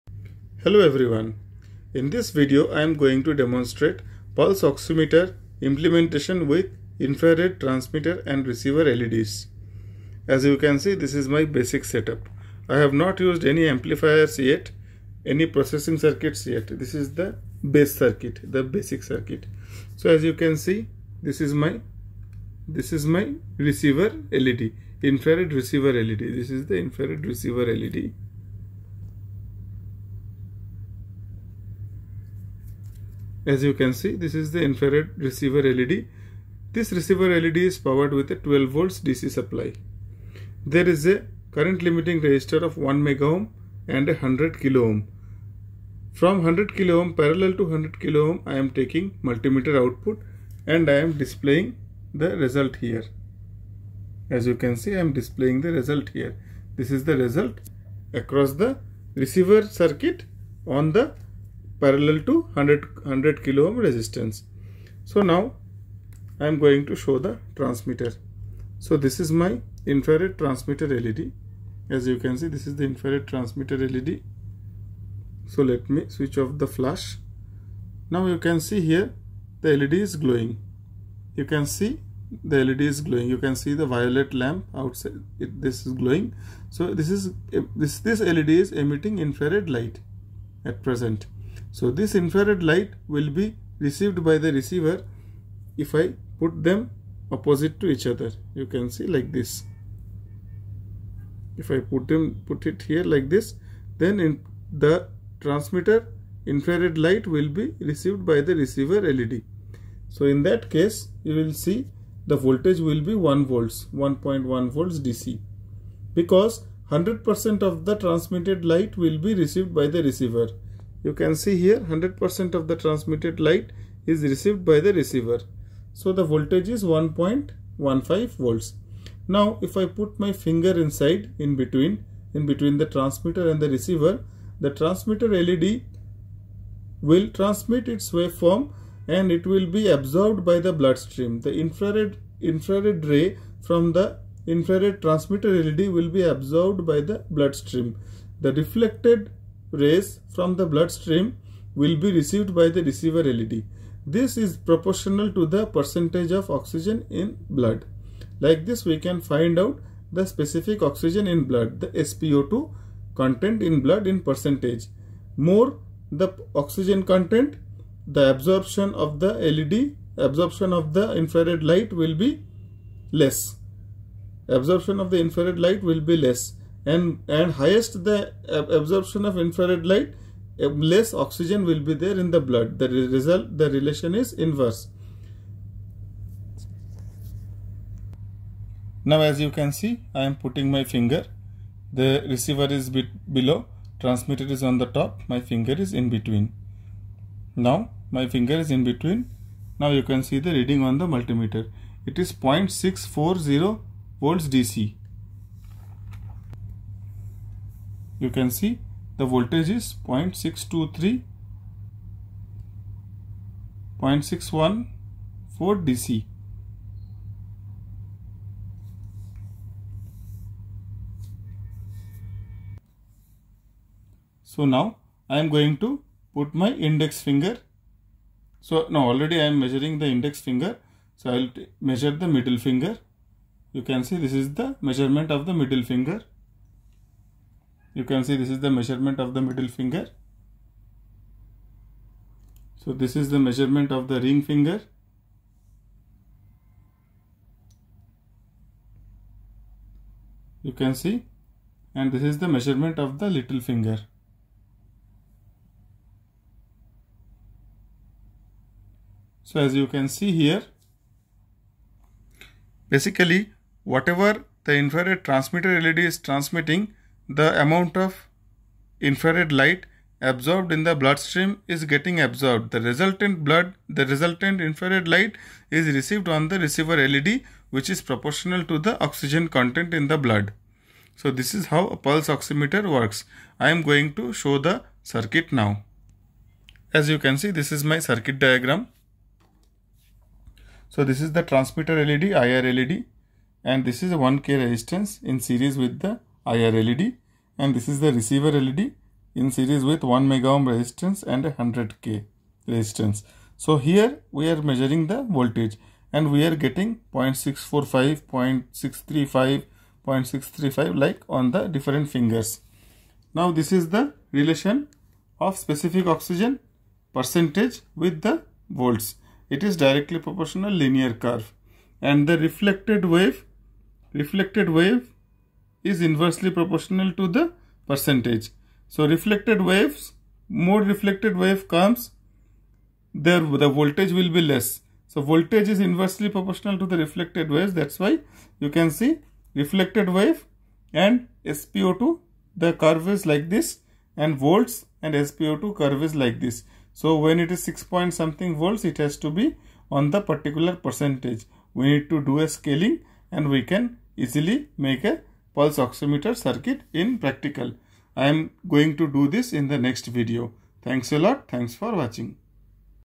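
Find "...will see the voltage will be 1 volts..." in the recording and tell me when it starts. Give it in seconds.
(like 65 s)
111 s.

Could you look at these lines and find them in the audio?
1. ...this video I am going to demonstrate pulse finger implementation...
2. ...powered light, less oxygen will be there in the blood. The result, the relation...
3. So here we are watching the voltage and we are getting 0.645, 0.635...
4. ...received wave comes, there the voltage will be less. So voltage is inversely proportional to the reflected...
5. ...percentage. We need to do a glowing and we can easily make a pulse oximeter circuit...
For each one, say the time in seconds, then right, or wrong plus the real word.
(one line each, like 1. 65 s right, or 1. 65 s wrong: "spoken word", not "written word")
1. 2 s wrong: "oximeter", not "finger"
2. 179 s wrong: "infrared", not "powered"
3. 303 s wrong: "measuring", not "watching"
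4. 330 s wrong: "reflected", not "received"
5. 350 s wrong: "scaling", not "glowing".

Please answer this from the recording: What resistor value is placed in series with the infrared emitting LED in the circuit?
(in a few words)
1K.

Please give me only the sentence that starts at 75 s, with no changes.
So let me switch off the flash.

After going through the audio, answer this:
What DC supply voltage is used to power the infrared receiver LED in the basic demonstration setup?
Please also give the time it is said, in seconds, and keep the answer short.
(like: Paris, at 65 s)
12 volts, at 38 s.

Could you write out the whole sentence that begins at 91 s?
So this infrared light will be received by the receiver if I put them opposite to each other.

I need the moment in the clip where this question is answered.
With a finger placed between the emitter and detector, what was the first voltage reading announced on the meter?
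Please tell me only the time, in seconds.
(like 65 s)
202 s.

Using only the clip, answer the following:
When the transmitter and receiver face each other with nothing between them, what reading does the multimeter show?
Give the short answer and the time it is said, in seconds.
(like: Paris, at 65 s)
1.15 volts, at 126 s.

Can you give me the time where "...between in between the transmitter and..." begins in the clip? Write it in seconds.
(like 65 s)
131 s.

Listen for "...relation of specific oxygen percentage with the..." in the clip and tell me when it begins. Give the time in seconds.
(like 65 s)
314 s.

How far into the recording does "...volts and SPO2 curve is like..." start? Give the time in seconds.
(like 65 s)
344 s.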